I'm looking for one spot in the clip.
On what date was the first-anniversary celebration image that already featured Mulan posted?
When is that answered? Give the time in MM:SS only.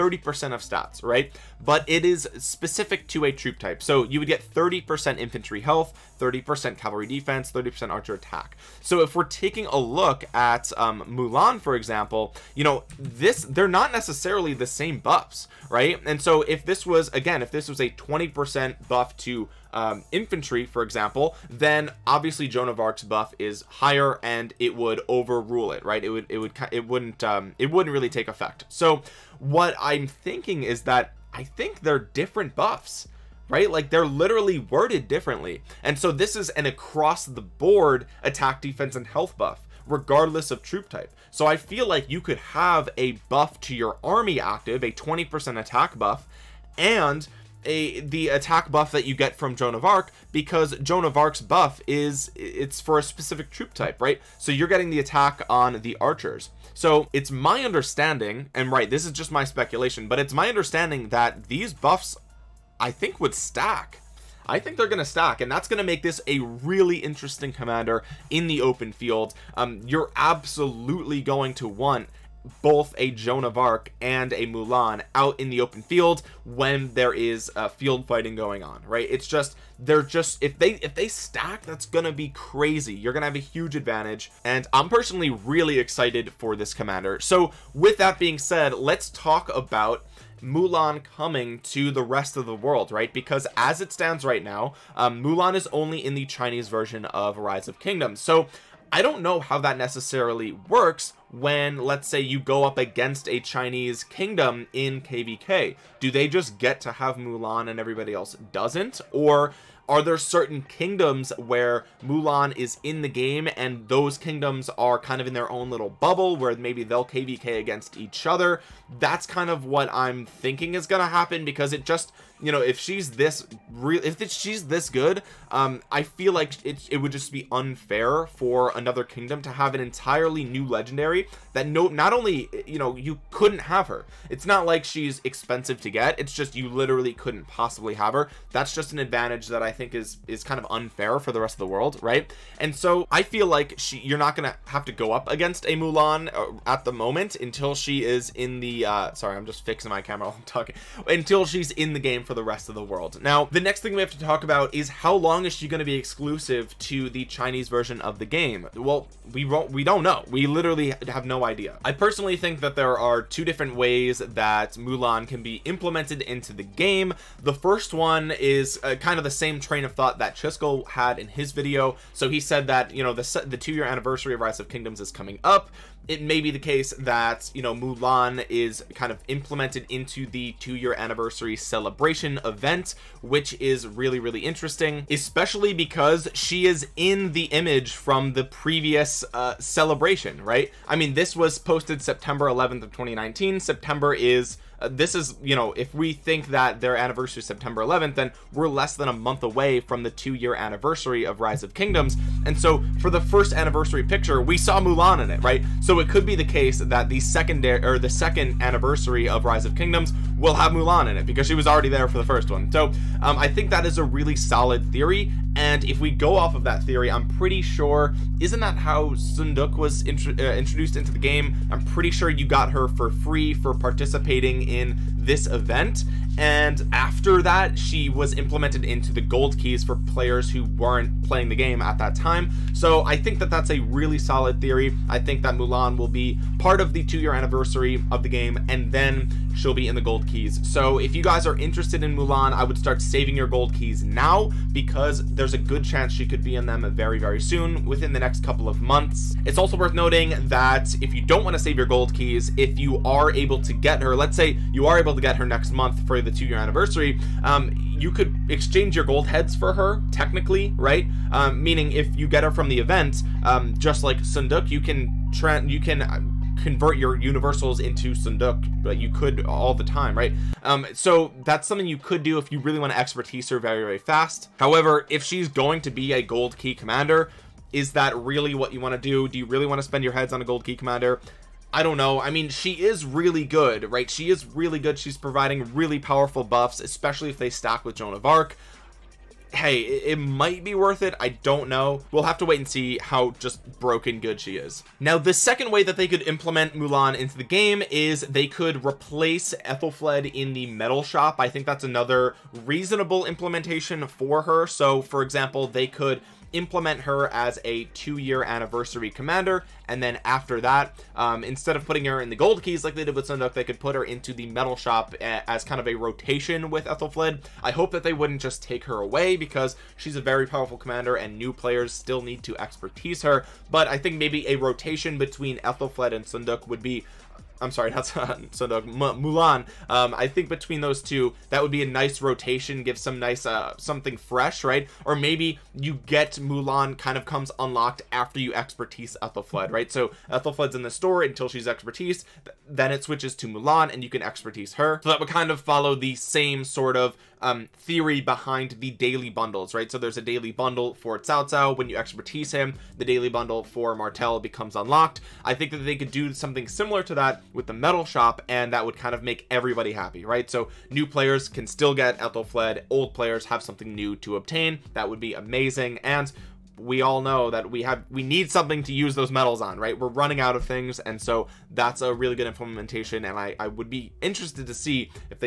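03:12.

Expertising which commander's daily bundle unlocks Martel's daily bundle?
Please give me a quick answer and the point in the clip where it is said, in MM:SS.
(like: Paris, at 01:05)
Cao Cao, at 05:51.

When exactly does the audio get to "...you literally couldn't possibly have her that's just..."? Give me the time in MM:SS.
02:16.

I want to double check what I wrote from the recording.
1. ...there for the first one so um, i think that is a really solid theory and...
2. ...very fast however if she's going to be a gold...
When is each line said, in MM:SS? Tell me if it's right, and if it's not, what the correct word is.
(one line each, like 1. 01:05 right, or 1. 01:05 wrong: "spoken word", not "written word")
1. 03:31 right
2. 04:33 right.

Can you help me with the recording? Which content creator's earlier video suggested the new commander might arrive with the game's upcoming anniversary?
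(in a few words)
Chisco.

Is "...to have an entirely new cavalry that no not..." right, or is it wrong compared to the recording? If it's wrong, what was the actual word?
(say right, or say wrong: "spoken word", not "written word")
wrong: "legendary", not "cavalry".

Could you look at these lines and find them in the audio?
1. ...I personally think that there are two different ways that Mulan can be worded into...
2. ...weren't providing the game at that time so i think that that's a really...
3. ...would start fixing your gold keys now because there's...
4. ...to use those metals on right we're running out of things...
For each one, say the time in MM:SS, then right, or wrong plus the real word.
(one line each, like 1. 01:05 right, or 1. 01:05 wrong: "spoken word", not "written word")
1. 02:41 wrong: "implemented", not "worded"
2. 03:50 wrong: "playing", not "providing"
3. 04:02 wrong: "saving", not "fixing"
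4. 06:08 right.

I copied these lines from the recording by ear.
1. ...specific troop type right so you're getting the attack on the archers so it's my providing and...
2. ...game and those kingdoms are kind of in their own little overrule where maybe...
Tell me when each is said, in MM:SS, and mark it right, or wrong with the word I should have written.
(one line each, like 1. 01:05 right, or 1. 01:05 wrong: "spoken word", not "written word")
1. 00:53 wrong: "understanding", not "providing"
2. 01:53 wrong: "bubble", not "overrule".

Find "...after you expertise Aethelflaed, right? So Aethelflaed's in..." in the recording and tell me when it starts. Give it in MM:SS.
05:38.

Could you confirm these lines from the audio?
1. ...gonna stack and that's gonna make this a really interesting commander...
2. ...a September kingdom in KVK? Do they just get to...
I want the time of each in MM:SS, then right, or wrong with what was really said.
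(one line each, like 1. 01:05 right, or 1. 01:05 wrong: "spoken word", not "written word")
1. 01:04 right
2. 01:43 wrong: "Chinese", not "September".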